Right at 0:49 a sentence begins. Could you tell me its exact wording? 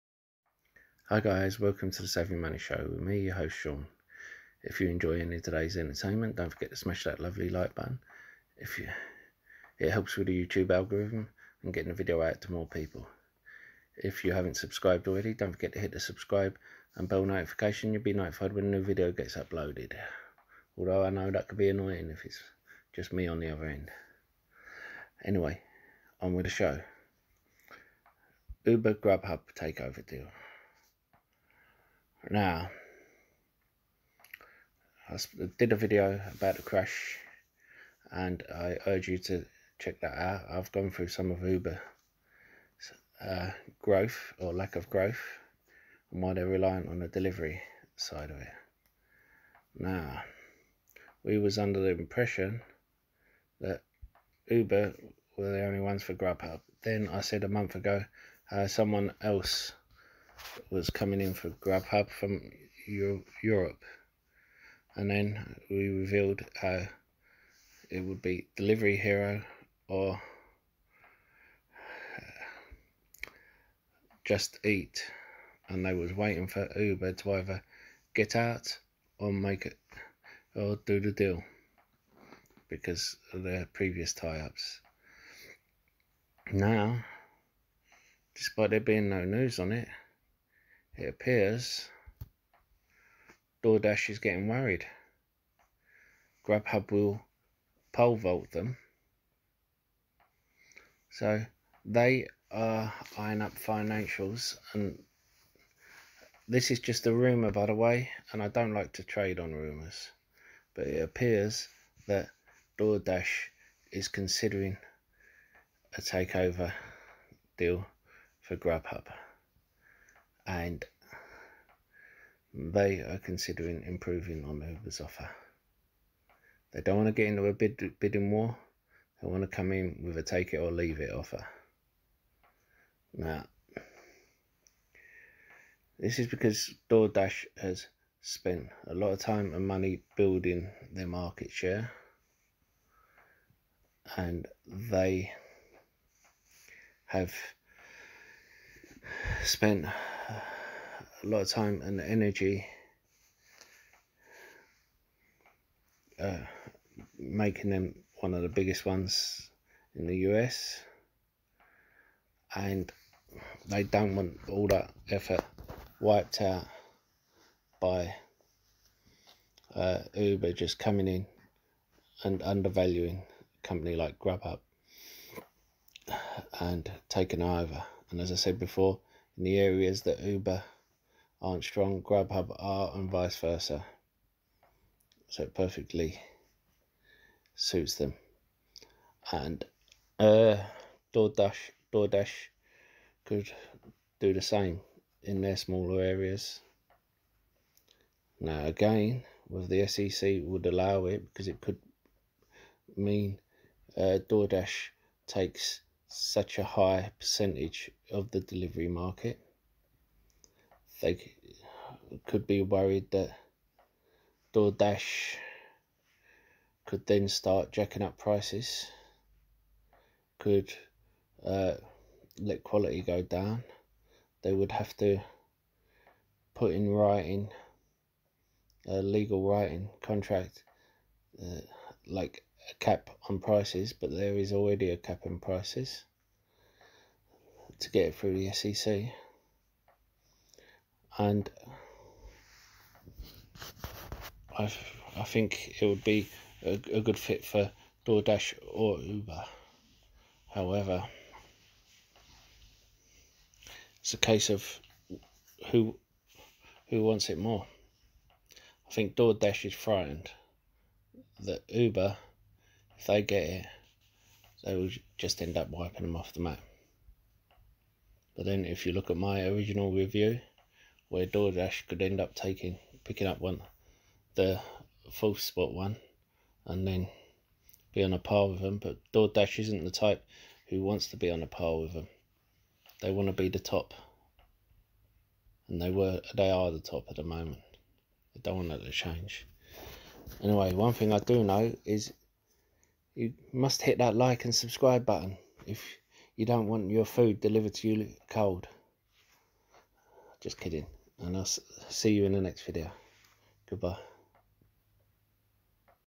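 Now, we was under the impression that Uber were the only ones for Grubhub.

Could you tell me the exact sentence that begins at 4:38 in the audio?
But DoorDash isn't the type who wants to be on a par with them.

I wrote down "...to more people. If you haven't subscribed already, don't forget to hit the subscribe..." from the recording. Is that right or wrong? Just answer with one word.
right.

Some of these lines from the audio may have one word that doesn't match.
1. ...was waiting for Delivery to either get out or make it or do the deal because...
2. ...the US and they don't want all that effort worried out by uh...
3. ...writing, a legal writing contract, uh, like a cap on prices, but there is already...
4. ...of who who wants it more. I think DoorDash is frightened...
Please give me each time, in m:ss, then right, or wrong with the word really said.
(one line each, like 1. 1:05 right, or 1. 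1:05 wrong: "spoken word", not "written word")
1. 1:15 wrong: "Uber", not "Delivery"
2. 2:40 wrong: "wiped", not "worried"
3. 3:46 right
4. 4:14 right.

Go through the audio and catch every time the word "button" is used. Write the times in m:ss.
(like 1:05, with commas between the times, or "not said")
0:07, 4:55.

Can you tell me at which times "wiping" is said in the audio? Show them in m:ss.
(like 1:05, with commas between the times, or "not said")
4:25.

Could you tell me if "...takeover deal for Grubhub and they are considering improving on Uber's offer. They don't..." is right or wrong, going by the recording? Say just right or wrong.
right.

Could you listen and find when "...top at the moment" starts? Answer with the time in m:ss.
4:46.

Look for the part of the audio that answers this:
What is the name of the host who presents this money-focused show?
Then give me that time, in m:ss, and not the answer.
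0:03.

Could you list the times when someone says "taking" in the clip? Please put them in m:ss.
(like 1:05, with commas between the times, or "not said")
2:57, 4:32.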